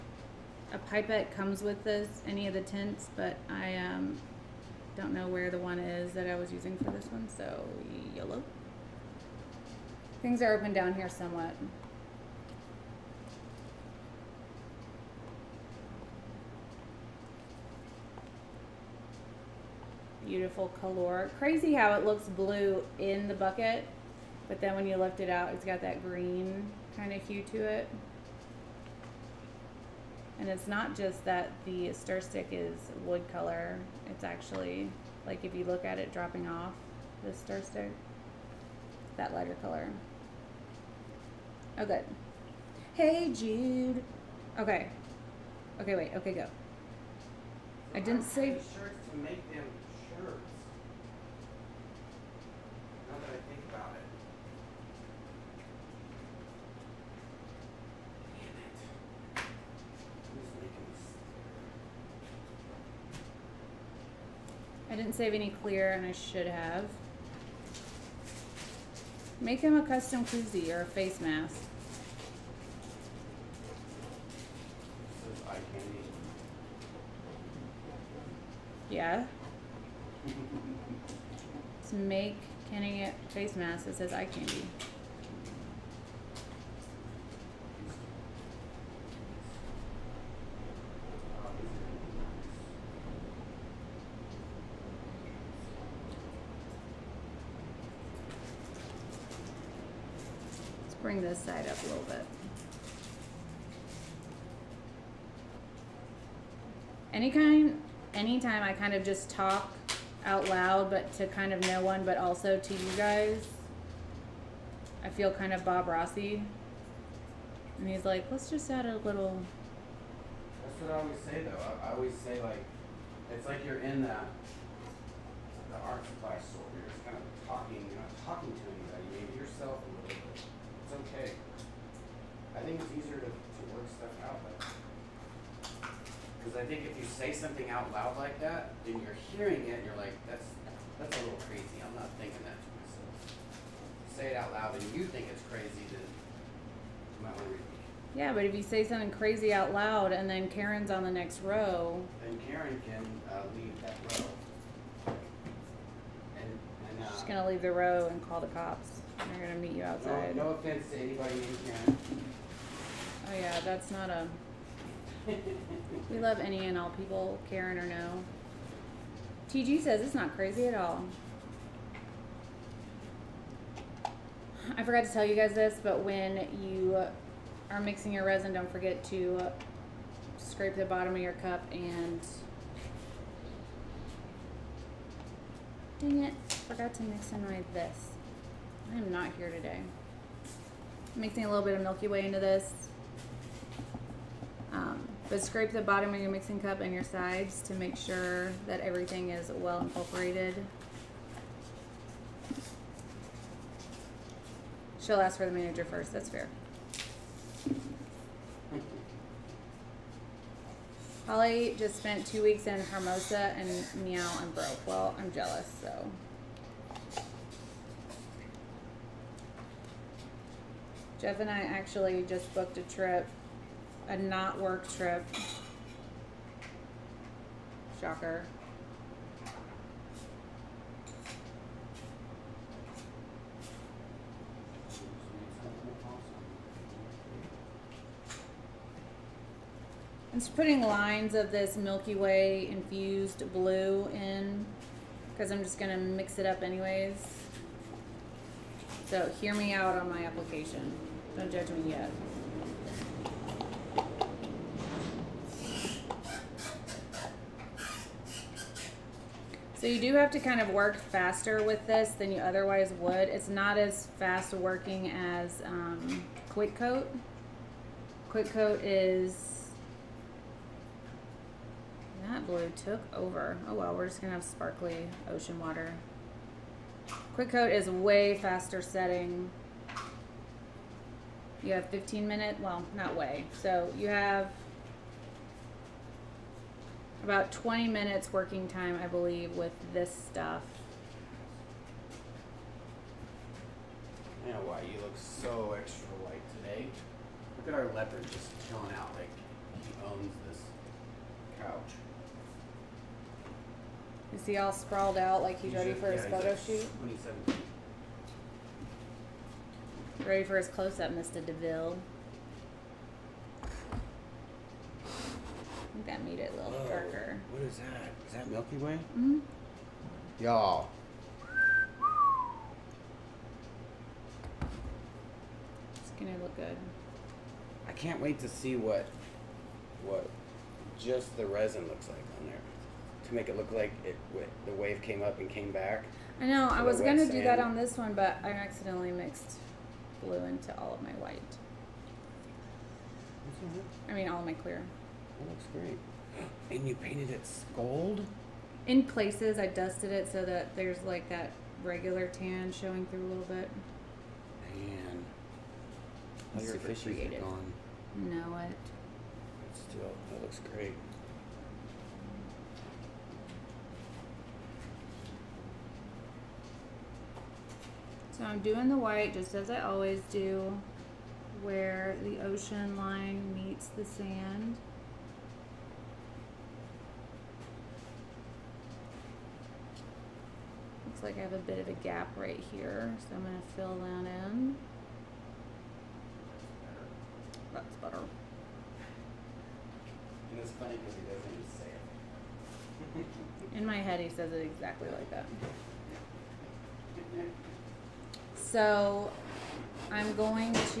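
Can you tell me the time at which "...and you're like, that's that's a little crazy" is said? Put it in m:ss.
2:19.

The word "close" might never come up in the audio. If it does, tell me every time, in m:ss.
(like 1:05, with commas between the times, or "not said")
5:10.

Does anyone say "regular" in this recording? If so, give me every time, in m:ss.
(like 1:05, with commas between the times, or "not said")
5:51.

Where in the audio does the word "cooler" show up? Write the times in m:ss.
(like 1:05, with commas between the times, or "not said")
not said.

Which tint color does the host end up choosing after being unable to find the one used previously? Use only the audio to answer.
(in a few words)
Yellow.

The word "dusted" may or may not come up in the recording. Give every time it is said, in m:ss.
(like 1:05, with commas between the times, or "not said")
5:49.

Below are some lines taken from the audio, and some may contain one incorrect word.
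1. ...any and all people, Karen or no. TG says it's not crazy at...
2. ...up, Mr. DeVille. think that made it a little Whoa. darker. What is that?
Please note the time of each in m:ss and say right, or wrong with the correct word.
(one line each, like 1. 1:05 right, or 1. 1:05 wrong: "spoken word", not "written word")
1. 2:46 right
2. 5:10 right.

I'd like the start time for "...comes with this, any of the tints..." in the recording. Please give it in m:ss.
0:01.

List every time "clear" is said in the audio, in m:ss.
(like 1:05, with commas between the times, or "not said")
1:05, 5:44.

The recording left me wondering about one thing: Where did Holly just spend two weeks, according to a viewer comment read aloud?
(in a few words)
Hermosa.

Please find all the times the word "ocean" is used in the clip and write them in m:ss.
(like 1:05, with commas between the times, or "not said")
4:35, 6:12.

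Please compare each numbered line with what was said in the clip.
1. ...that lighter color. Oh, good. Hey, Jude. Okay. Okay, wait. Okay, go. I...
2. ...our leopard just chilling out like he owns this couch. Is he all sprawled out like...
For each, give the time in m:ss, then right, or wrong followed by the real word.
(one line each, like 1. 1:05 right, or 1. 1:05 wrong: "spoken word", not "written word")
1. 0:39 right
2. 4:57 right.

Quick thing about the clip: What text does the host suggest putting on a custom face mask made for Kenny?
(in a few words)
Eye candy.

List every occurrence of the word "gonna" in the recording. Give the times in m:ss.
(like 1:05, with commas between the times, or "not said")
4:05, 4:34, 5:26, 5:36.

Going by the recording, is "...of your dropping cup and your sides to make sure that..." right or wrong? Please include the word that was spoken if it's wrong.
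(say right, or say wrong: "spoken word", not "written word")
wrong: "mixing", not "dropping".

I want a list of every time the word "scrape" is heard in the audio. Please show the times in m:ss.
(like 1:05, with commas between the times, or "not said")
3:00, 3:15.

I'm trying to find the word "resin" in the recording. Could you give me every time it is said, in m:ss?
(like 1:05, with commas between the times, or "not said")
2:58, 5:31.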